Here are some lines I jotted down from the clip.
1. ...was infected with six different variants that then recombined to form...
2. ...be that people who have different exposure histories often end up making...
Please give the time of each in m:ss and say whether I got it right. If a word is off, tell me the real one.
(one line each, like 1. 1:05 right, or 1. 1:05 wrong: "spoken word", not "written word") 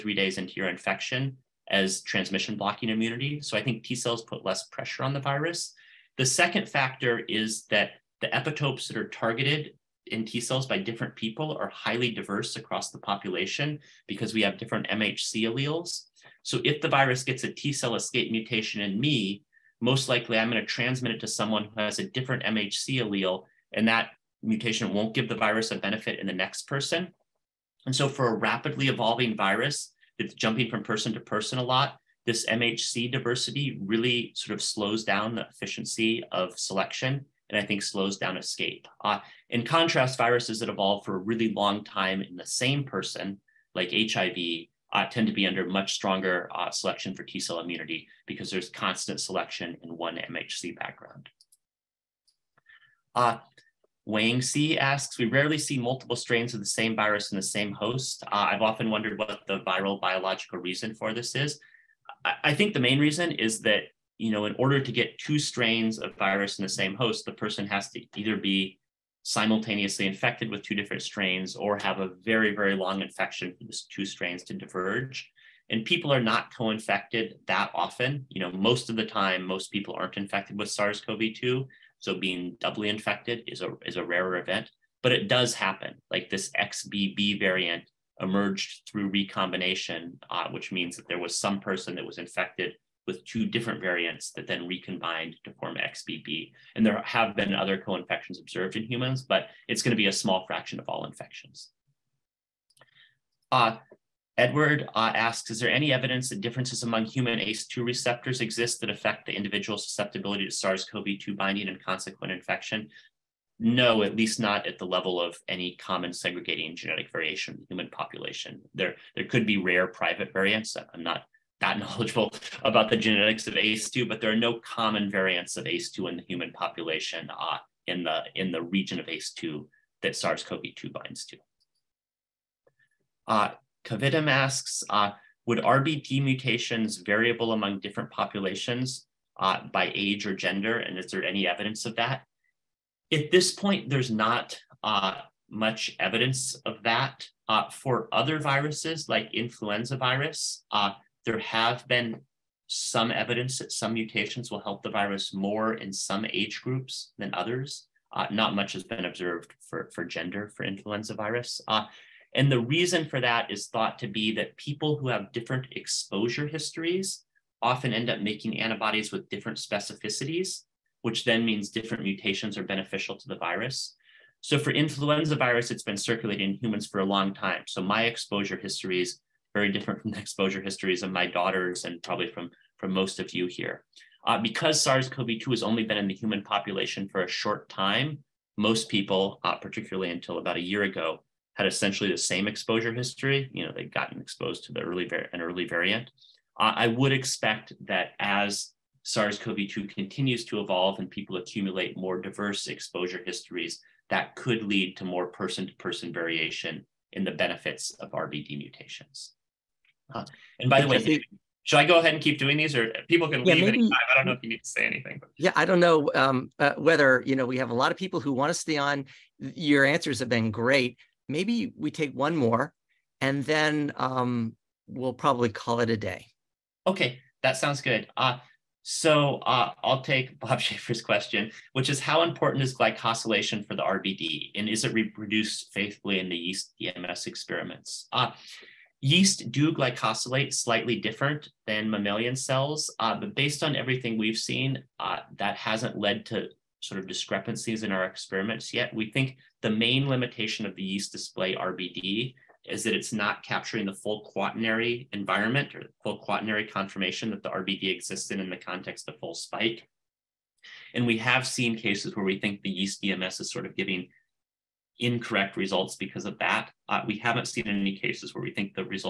1. 1:32 wrong: "two", not "six"
2. 2:44 right.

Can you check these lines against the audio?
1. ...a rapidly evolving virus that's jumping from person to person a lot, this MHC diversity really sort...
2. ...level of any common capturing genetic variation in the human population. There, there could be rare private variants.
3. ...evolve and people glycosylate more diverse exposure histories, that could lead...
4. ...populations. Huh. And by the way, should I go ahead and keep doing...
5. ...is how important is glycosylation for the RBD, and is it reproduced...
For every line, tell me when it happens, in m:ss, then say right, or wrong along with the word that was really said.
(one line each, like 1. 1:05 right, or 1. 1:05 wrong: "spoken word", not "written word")
1. 0:28 right
2. 1:54 wrong: "segregating", not "capturing"
3. 3:20 wrong: "accumulate", not "glycosylate"
4. 3:28 wrong: "mutations", not "populations"
5. 3:51 right.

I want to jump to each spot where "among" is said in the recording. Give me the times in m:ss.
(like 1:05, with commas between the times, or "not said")
1:46, 2:17.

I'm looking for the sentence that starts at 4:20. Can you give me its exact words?
And we have seen cases where we think the yeast DMS is sort of giving incorrect results because of that.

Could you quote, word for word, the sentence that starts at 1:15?
And people are not co infected that often.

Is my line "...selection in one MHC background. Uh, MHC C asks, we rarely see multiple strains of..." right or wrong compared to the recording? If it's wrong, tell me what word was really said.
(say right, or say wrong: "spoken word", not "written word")
wrong: "Wang", not "MHC".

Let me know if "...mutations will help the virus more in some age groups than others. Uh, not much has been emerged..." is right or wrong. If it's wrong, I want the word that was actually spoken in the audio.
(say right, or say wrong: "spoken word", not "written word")
wrong: "observed", not "emerged".